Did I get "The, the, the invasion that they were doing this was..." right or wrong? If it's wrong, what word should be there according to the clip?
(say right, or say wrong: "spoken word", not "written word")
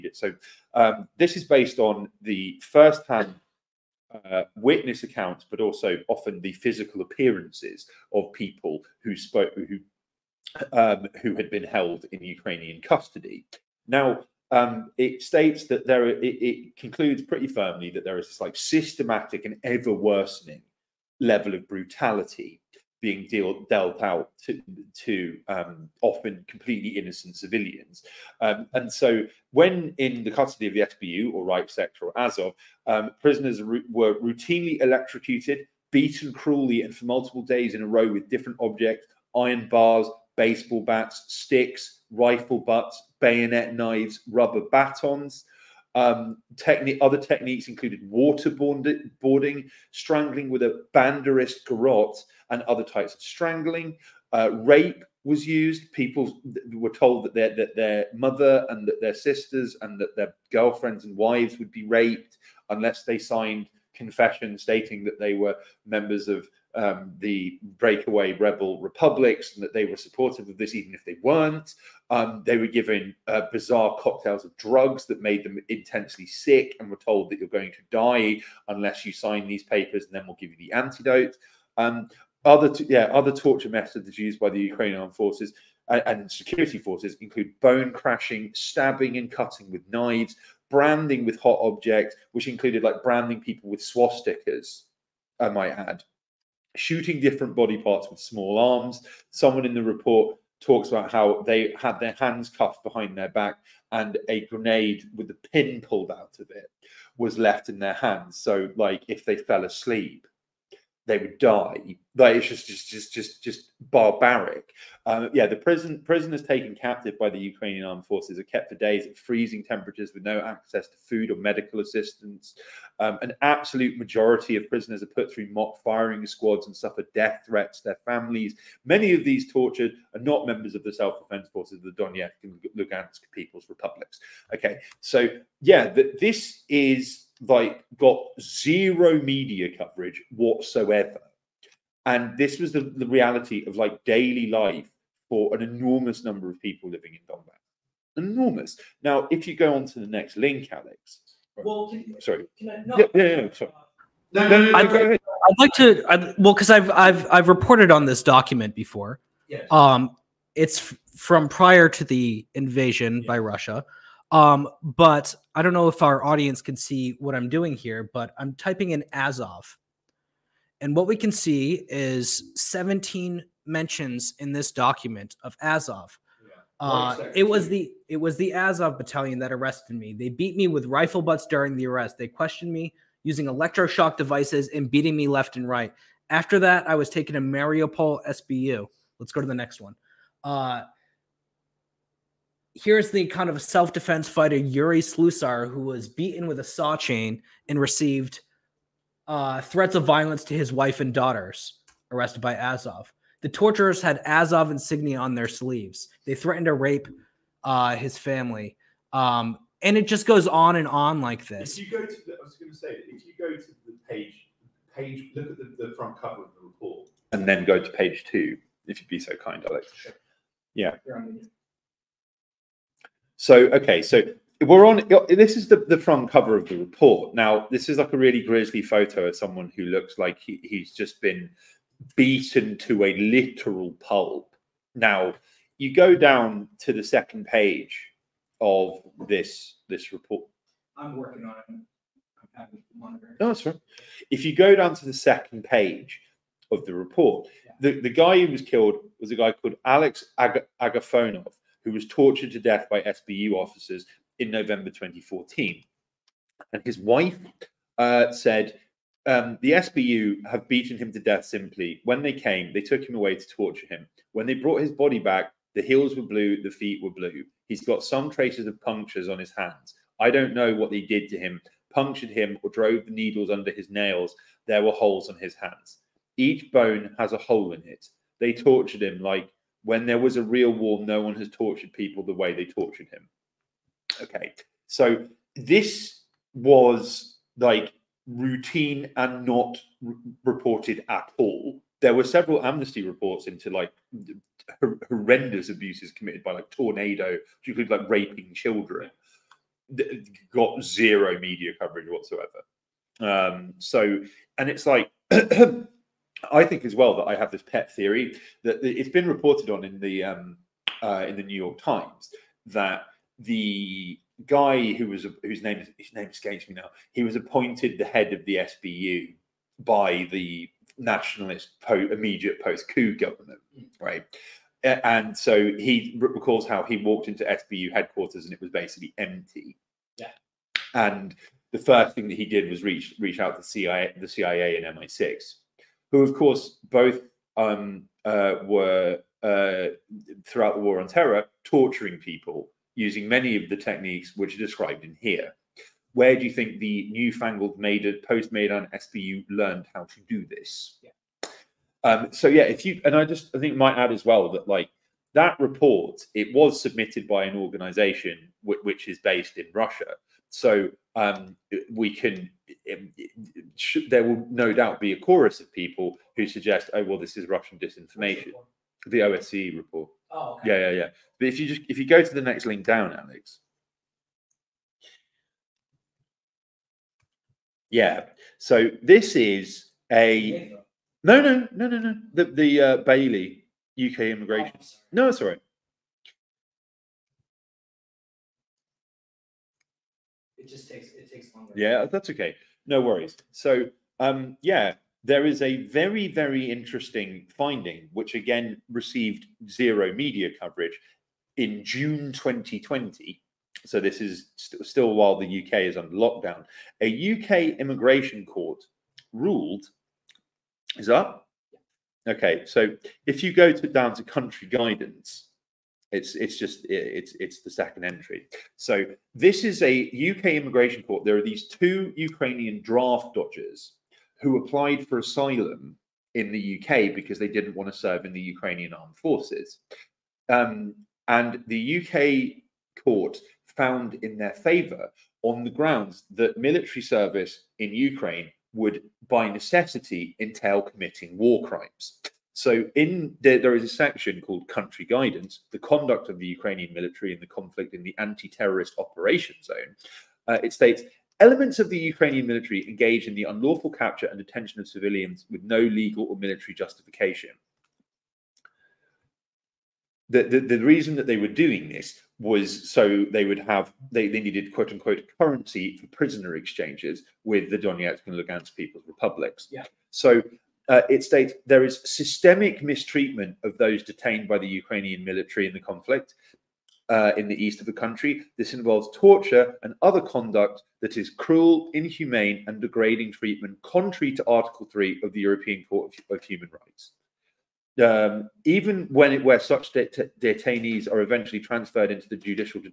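wrong: "reason", not "invasion".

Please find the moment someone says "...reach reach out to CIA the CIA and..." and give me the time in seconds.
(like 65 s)
332 s.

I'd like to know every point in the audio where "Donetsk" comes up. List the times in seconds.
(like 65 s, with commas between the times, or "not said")
132 s, 467 s.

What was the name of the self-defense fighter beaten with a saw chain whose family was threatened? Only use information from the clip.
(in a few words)
Yuri Slusar.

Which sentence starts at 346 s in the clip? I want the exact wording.
Where do you think the newfangled Maidan, post Maidan SBU learned how to do this?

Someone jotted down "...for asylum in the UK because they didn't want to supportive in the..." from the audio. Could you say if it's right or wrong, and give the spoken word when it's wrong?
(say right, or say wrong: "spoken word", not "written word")
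wrong: "serve", not "supportive".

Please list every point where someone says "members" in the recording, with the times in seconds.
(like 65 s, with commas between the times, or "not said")
65 s, 130 s.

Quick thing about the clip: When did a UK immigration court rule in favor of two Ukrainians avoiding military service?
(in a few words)
June 2020.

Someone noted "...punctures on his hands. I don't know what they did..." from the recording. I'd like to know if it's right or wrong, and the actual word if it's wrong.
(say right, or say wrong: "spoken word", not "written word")
right.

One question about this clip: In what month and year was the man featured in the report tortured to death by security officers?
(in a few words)
November 2014.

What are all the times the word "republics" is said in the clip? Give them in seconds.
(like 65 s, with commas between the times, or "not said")
68 s, 133 s, 469 s.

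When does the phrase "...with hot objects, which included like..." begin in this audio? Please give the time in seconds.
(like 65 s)
91 s.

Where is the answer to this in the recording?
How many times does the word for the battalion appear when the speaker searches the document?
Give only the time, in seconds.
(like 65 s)
172 s.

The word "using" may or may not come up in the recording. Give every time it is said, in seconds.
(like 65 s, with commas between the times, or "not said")
183 s, 342 s.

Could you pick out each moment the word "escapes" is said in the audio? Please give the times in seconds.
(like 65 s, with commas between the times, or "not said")
316 s.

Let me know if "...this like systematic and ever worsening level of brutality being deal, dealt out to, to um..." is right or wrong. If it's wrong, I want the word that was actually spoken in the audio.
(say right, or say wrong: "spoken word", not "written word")
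right.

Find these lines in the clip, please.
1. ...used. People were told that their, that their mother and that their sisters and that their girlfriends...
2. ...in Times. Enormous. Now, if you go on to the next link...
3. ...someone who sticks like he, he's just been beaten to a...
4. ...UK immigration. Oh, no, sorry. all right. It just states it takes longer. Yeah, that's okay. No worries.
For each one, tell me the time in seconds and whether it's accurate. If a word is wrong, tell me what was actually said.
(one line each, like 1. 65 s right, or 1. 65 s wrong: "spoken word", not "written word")
1. 55 s right
2. 147 s wrong: "Donbass", not "Times"
3. 229 s wrong: "looks", not "sticks"
4. 383 s wrong: "takes", not "states".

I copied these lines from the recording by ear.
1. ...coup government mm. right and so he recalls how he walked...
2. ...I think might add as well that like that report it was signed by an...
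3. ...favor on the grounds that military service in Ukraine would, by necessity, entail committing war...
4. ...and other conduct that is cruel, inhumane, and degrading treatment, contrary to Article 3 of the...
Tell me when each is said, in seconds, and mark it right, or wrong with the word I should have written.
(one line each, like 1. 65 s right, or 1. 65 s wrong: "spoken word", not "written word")
1. 322 s right
2. 353 s wrong: "submitted", not "signed"
3. 434 s right
4. 479 s right.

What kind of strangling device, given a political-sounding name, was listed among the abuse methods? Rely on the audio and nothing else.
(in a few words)
banderist garrote.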